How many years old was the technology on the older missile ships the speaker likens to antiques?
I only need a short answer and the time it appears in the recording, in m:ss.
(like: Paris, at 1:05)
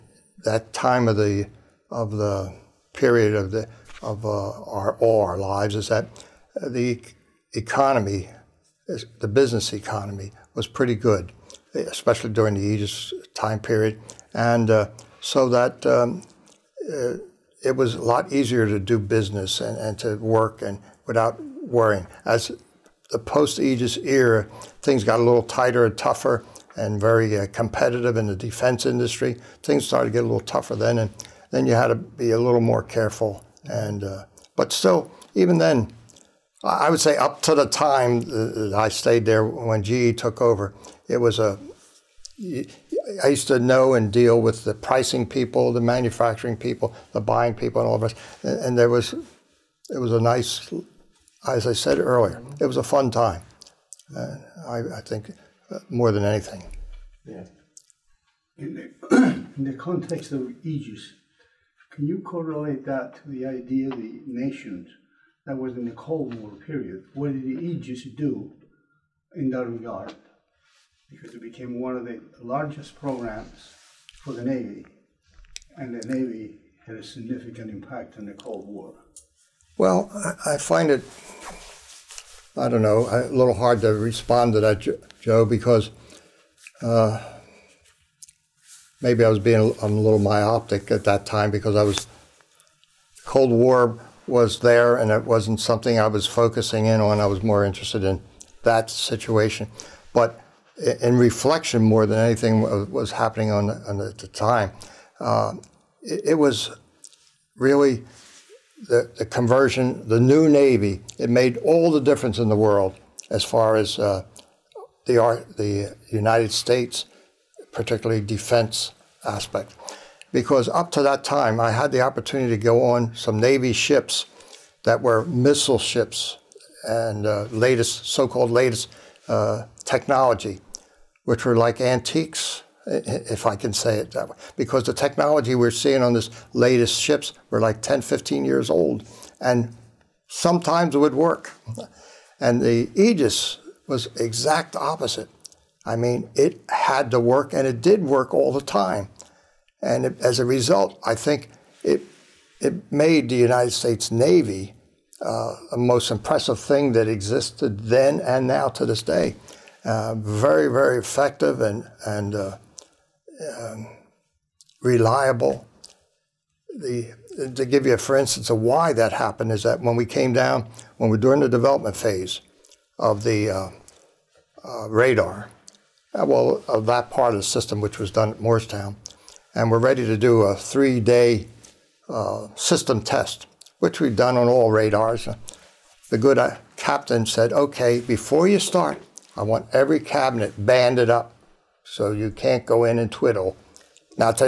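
10, 15 years, at 2:17.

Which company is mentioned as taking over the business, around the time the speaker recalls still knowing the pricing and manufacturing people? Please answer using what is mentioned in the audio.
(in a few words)
GE.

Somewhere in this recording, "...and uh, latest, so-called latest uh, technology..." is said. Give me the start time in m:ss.
2:06.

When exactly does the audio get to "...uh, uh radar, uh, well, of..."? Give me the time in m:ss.
2:53.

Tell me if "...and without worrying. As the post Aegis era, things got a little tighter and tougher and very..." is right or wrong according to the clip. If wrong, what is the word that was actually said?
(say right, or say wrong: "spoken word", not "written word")
right.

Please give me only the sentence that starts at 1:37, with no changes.
I was more interested in that situation.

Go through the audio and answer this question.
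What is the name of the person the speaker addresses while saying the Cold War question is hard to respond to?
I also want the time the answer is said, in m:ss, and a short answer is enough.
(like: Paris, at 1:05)
Joe, at 1:25.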